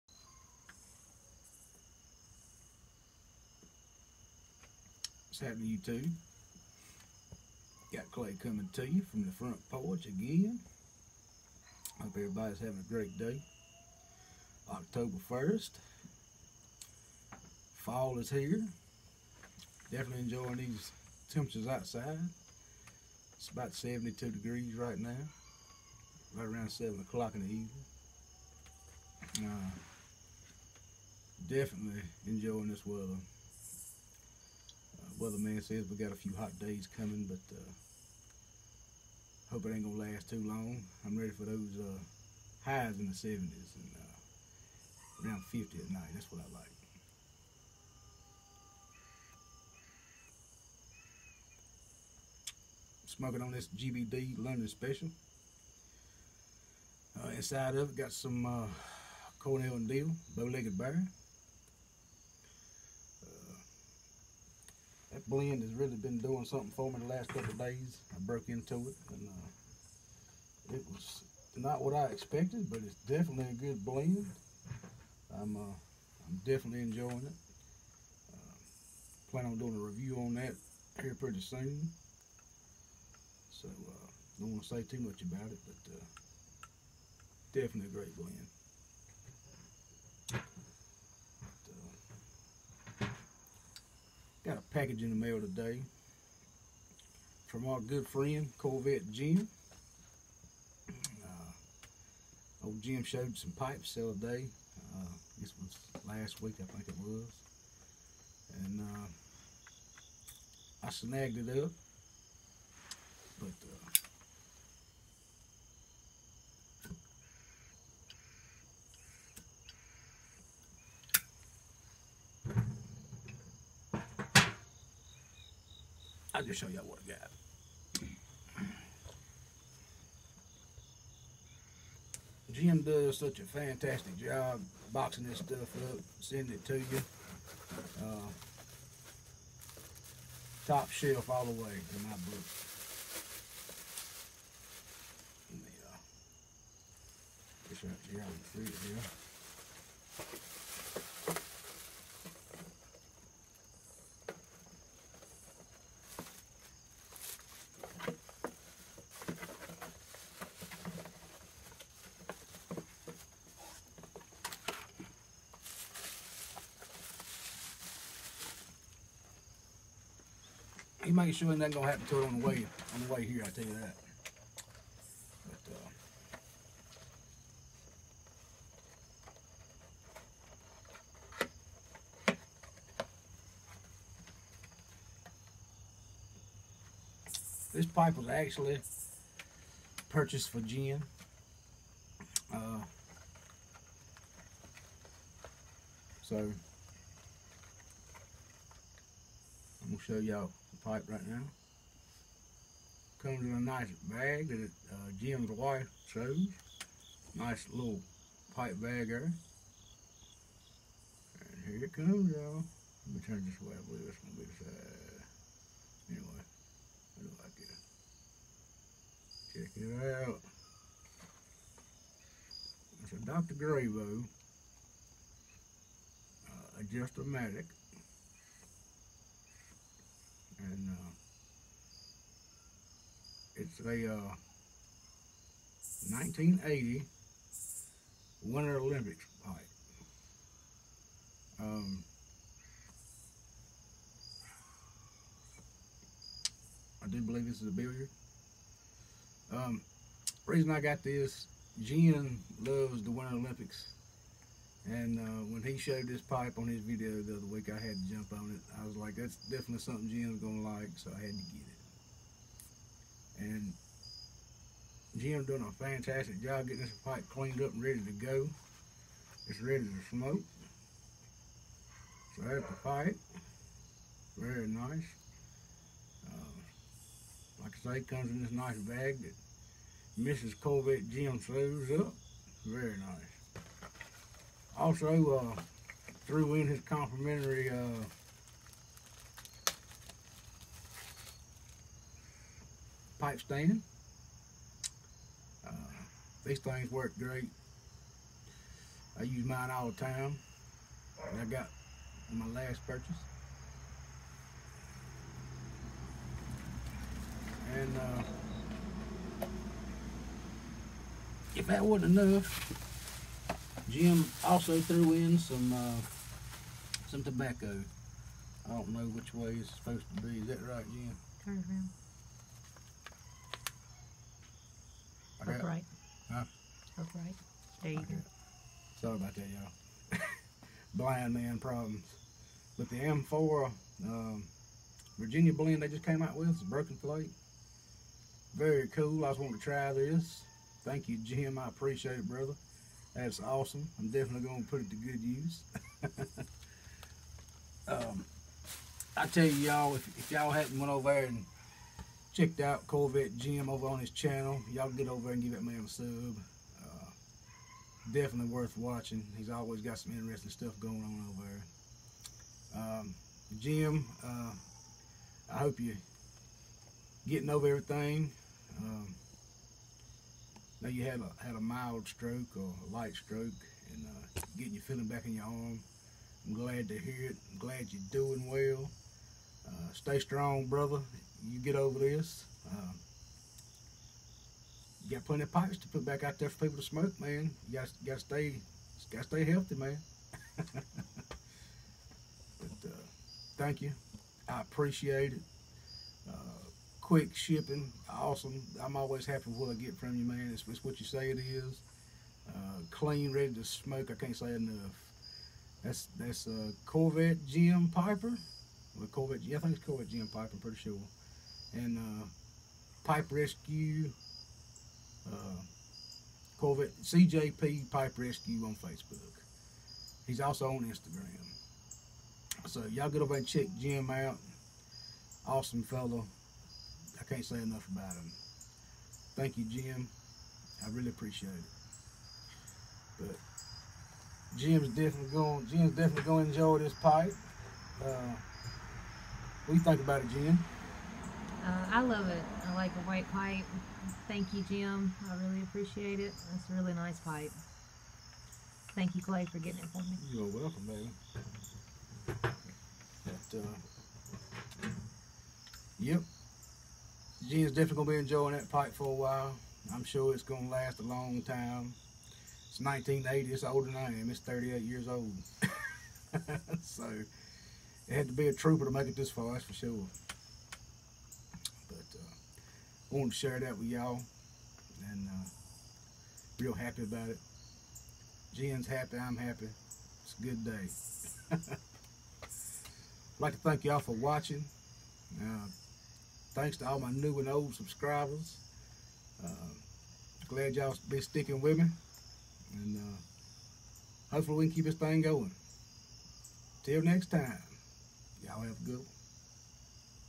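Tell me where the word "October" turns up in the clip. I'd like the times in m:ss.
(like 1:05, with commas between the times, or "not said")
0:14.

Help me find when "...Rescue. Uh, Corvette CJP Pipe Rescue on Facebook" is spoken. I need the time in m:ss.
6:53.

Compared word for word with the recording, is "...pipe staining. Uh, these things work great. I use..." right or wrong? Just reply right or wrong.
right.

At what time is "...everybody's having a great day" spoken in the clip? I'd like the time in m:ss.
0:12.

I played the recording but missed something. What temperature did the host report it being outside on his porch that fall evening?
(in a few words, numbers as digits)
72 degrees.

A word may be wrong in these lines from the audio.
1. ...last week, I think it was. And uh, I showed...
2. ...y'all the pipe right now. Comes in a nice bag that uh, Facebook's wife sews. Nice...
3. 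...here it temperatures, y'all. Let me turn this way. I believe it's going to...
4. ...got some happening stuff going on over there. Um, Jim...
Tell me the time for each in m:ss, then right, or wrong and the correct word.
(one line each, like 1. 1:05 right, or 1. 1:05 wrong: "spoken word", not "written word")
1. 1:46 wrong: "snagged", not "showed"
2. 3:20 wrong: "Jim", not "Facebook"
3. 3:31 wrong: "comes", not "temperatures"
4. 5:59 wrong: "interesting", not "happening".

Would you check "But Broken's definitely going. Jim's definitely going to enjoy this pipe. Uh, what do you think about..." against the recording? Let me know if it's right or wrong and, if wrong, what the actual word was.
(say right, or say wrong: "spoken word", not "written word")
wrong: "Jim", not "Broken".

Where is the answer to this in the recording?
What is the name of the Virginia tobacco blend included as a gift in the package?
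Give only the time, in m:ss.
5:36.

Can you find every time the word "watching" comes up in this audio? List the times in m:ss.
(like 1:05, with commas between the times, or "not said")
5:58, 8:04.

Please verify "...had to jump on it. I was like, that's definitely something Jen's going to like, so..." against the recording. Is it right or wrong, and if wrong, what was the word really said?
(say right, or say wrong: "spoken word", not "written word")
right.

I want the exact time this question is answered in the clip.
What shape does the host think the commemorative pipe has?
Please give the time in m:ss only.
4:07.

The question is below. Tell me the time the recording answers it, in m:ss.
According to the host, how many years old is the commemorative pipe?
7:44.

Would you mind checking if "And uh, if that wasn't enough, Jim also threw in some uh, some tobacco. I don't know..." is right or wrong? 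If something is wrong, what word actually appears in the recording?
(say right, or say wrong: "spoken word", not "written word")
right.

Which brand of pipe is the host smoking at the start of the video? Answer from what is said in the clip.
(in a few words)
GBD London Special.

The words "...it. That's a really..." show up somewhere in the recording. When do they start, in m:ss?
7:26.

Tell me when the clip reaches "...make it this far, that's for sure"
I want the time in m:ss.
7:48.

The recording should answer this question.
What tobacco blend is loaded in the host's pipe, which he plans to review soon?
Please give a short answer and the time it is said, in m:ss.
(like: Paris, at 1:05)
Bow-legged Bear, at 1:00.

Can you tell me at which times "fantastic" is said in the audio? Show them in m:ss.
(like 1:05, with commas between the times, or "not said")
2:13, 4:25.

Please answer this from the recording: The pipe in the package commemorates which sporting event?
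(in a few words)
1980 Winter Olympics.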